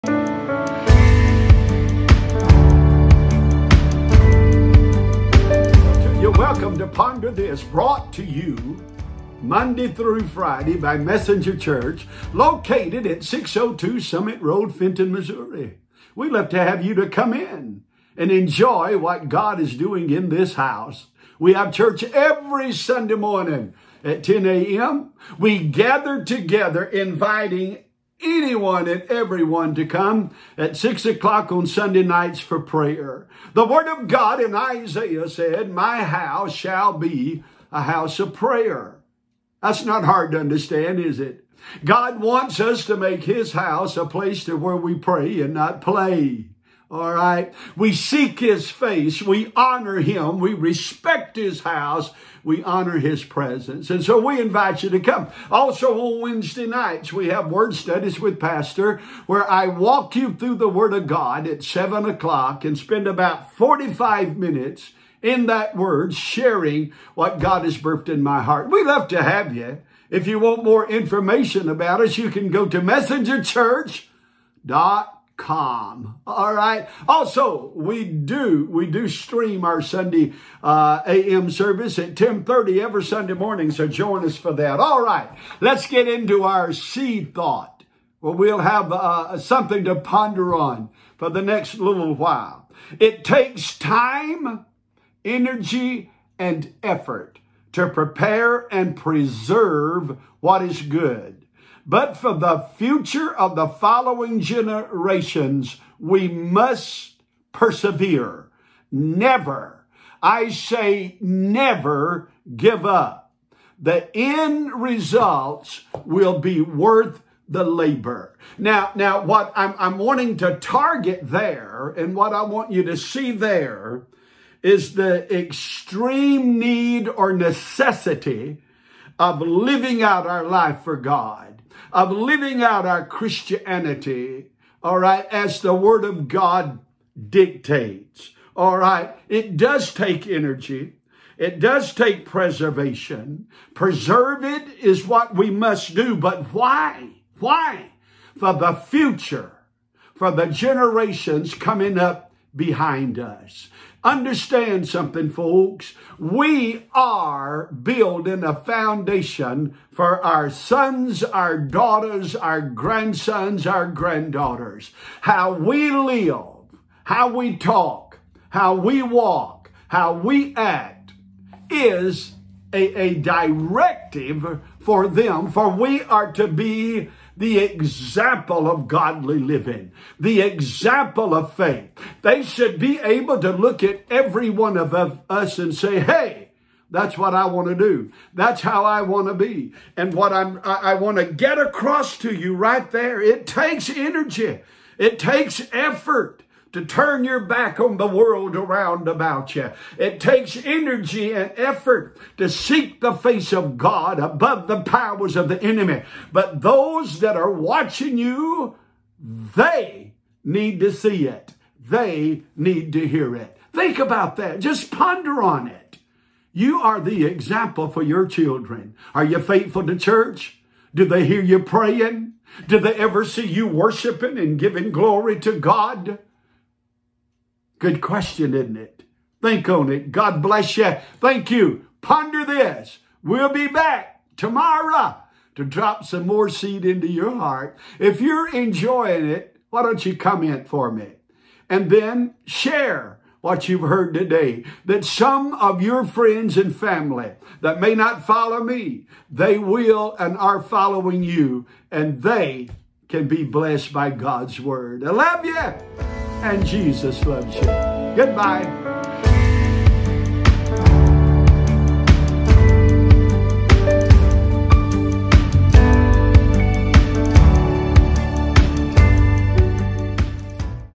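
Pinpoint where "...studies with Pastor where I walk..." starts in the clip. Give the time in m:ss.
0:57.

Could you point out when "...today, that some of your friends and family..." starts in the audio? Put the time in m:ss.
4:04.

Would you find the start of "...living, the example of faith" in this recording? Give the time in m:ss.
2:59.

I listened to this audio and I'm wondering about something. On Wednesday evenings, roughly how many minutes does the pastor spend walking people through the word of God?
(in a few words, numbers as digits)
45.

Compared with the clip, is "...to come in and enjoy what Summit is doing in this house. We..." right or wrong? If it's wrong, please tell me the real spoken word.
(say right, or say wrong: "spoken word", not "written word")
wrong: "God", not "Summit".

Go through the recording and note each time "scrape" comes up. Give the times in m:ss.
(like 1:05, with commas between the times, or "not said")
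not said.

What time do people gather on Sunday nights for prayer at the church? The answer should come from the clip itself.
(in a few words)
6 o'clock.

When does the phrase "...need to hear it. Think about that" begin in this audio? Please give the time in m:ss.
3:32.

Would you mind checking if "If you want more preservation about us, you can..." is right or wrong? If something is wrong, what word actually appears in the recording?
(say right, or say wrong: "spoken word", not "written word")
wrong: "information", not "preservation".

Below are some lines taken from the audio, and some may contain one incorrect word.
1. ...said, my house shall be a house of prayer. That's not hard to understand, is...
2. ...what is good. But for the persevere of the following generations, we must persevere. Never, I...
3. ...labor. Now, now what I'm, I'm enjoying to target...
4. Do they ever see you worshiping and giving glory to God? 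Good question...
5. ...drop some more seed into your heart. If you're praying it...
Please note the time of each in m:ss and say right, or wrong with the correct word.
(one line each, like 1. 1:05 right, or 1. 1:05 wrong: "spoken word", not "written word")
1. 0:35 right
2. 1:40 wrong: "future", not "persevere"
3. 1:57 wrong: "wanting", not "enjoying"
4. 3:42 right
5. 3:55 wrong: "enjoying", not "praying".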